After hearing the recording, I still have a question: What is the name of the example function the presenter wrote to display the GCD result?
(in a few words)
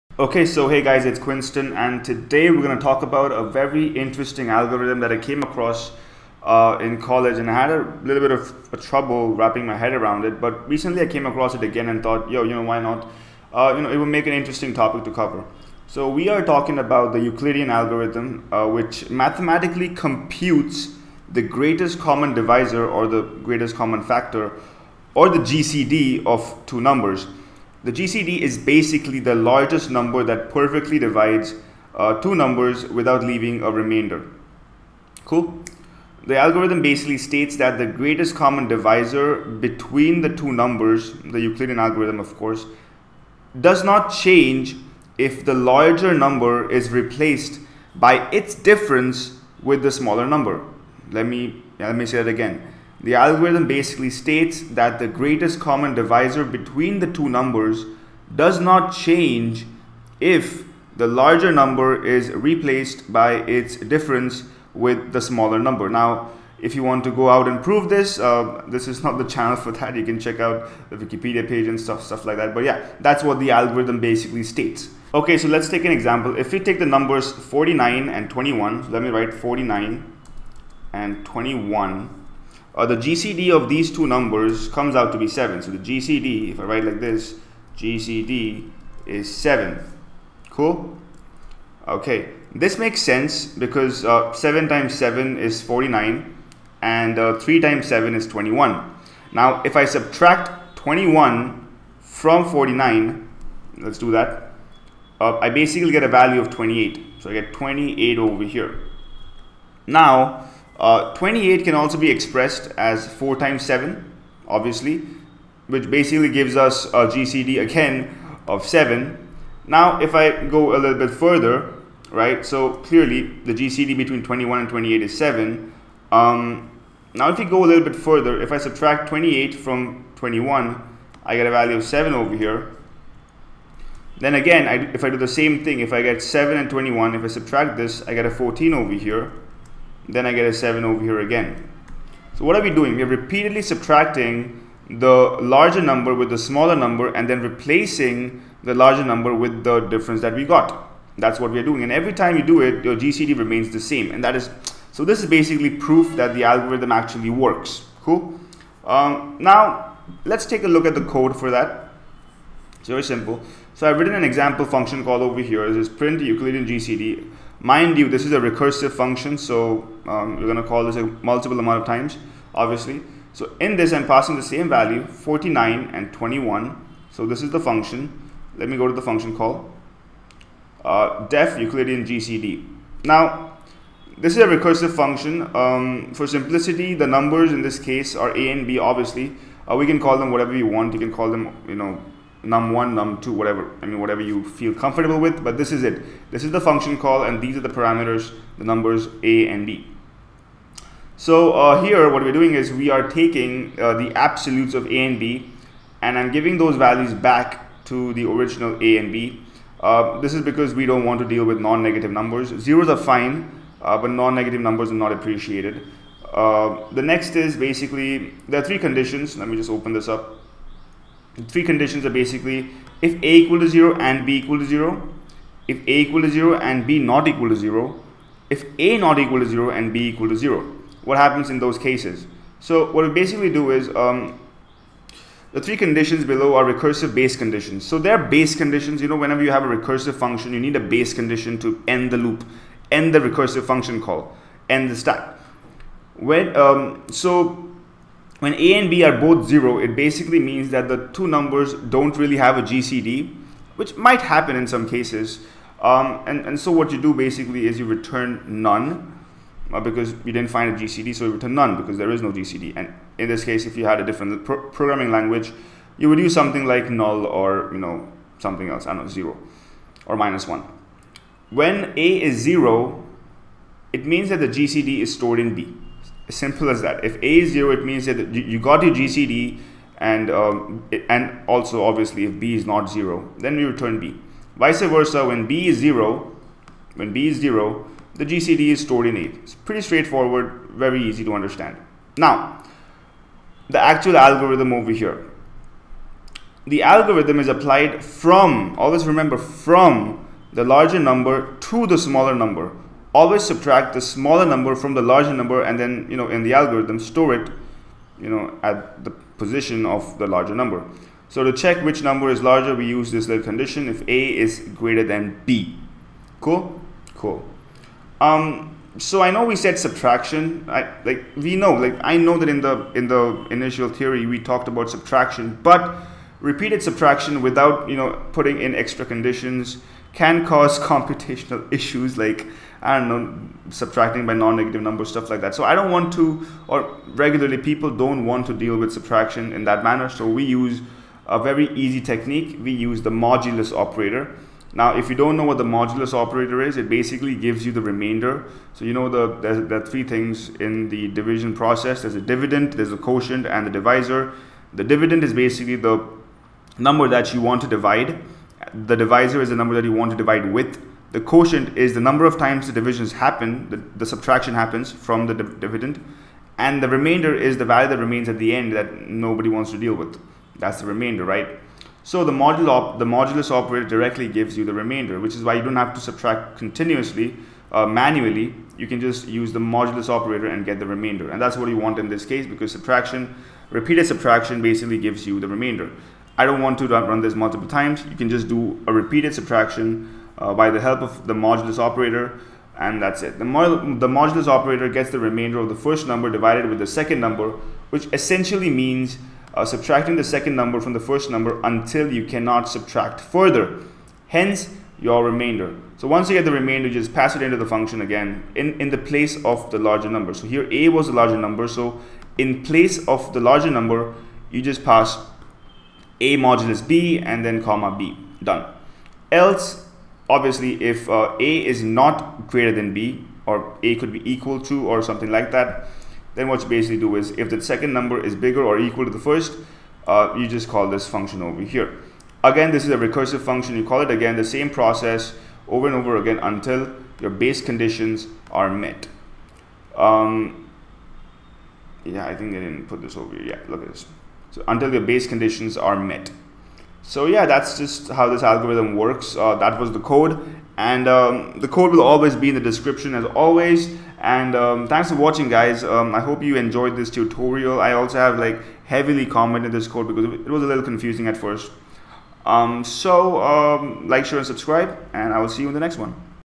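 print Euclidean GCD.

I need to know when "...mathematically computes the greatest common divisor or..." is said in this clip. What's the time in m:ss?
0:19.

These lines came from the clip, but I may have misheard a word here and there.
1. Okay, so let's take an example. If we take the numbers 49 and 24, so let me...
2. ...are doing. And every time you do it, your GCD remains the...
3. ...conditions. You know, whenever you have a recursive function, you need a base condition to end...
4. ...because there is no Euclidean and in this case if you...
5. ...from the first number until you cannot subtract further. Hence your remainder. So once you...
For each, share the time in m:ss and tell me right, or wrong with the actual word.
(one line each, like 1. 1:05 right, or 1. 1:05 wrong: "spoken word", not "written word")
1. 1:15 wrong: "21", not "24"
2. 2:31 right
3. 3:58 right
4. 4:21 wrong: "GCD", not "Euclidean"
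5. 6:40 right.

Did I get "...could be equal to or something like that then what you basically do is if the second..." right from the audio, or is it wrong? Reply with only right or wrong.
right.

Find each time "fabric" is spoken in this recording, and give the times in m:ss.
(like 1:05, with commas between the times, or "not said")
not said.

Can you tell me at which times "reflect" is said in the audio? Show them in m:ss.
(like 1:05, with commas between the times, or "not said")
not said.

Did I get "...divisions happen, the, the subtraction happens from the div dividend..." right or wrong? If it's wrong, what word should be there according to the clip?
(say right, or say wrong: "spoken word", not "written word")
right.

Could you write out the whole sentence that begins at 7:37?
I also have like heavily commented this code because it was a little confusing at first.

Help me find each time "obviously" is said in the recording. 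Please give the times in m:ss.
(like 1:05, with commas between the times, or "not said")
1:54, 2:52, 3:08, 4:41, 7:00.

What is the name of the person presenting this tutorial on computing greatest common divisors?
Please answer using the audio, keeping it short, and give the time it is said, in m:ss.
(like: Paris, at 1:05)
Quinston, at 0:01.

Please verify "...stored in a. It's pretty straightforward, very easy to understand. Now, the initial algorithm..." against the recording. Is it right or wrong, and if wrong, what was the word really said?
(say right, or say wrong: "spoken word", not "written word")
wrong: "actual", not "initial".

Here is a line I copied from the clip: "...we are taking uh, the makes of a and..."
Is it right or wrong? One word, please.
wrong.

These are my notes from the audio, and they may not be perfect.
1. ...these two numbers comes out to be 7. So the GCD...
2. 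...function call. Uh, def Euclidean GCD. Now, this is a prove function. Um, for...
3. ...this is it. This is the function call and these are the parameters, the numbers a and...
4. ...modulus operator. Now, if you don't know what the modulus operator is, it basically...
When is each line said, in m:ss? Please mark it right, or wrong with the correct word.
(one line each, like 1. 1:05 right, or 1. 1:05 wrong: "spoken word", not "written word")
1. 1:23 right
2. 2:59 wrong: "recursive", not "prove"
3. 3:15 right
4. 5:43 right.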